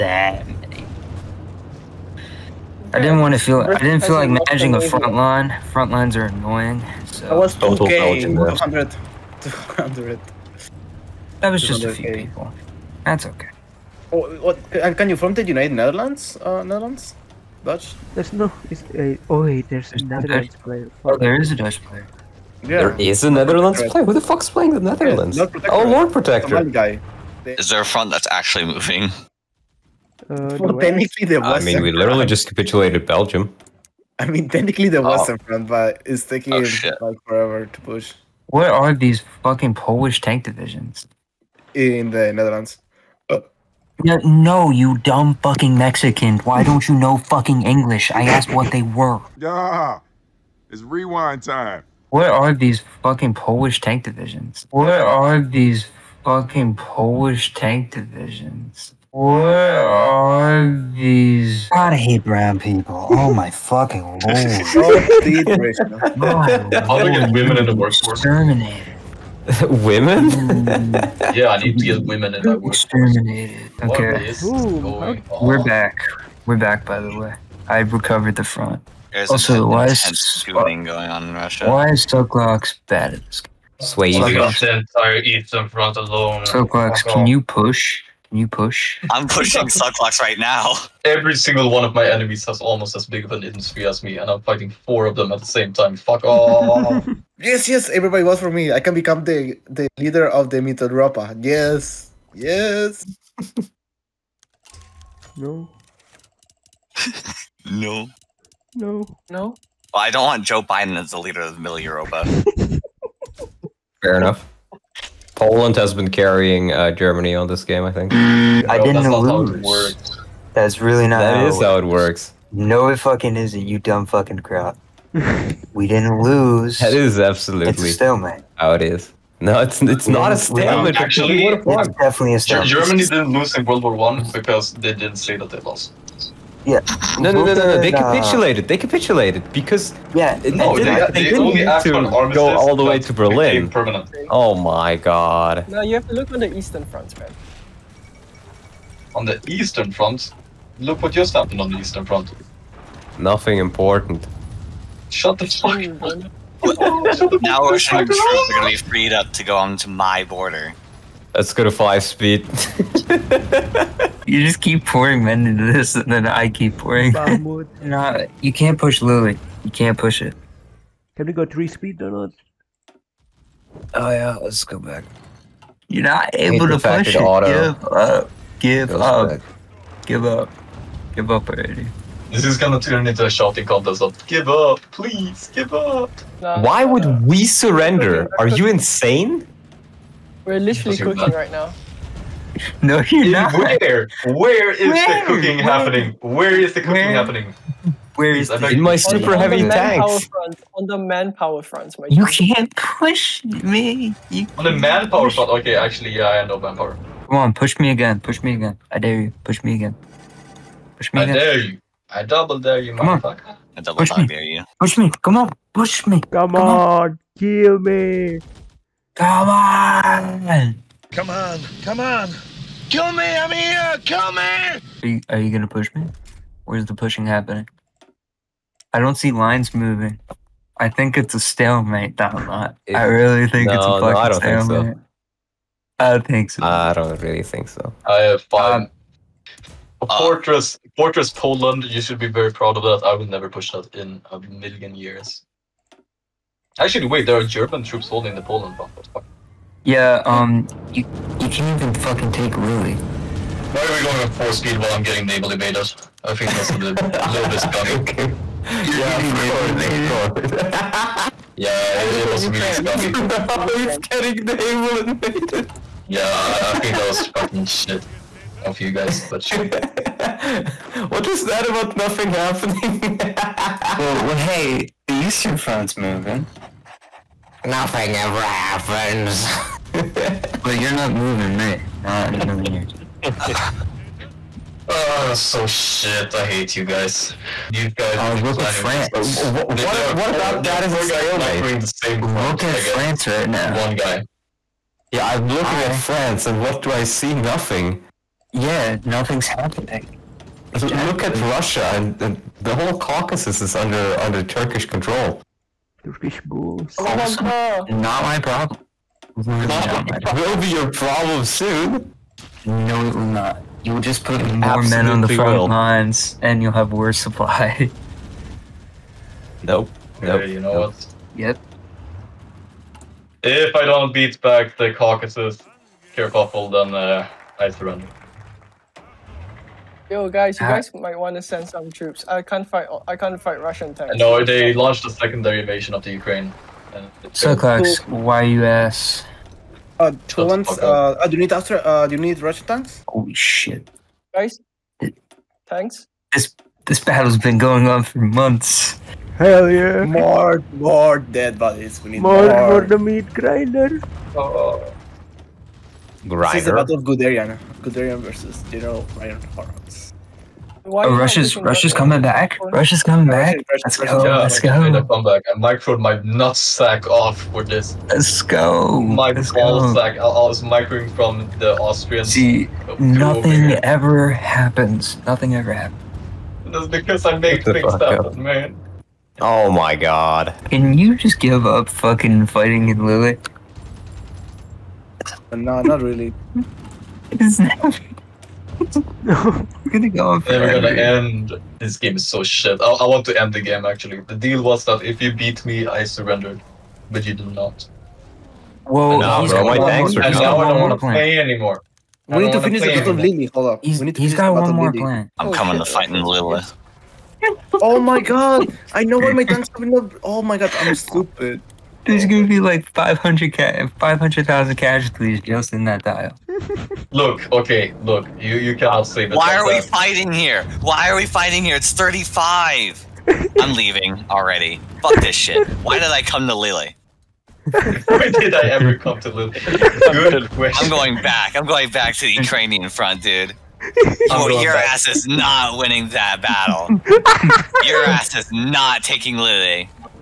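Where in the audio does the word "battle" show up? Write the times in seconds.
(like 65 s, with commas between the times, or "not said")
346 s, 356 s, 402 s, 436 s.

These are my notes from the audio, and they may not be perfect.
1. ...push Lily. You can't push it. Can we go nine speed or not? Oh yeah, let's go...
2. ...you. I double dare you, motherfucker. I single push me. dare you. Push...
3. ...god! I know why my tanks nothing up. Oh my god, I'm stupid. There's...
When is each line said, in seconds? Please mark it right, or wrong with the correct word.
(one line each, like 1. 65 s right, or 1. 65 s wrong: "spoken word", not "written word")
1. 168 s wrong: "three", not "nine"
2. 211 s wrong: "double", not "single"
3. 408 s wrong: "coming", not "nothing".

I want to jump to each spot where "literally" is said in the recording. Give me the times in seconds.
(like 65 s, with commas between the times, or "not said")
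31 s, 190 s.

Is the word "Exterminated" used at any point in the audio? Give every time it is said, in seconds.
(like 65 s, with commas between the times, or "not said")
68 s, 73 s.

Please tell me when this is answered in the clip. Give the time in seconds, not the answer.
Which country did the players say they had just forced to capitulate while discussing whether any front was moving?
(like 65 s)
33 s.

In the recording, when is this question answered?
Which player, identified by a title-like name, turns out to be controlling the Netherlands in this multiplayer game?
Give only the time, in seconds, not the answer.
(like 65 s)
25 s.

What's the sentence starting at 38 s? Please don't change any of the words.
Where are these fucking Polish tank divisions?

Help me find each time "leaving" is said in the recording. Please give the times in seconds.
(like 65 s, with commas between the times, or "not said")
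423 s.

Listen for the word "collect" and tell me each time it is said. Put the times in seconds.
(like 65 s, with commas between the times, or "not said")
not said.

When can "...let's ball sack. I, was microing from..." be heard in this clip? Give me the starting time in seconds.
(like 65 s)
369 s.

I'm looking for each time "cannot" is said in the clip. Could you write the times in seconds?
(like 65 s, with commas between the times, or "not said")
418 s.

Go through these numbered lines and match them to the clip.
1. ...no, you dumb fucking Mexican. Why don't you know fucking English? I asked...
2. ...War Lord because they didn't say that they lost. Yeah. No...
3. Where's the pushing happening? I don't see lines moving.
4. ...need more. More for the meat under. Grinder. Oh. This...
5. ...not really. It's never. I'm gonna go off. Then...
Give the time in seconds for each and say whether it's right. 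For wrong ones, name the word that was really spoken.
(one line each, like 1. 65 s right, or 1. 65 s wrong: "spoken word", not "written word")
1. 44 s right
2. 133 s wrong: "One", not "Lord"
3. 226 s right
4. 352 s wrong: "grinder", not "under"
5. 385 s right.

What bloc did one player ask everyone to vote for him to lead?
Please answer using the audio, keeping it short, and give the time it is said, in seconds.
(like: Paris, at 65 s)
Mitteleuropa, at 100 s.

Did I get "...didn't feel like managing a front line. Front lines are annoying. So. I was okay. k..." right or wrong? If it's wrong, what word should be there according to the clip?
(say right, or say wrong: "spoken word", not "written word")
right.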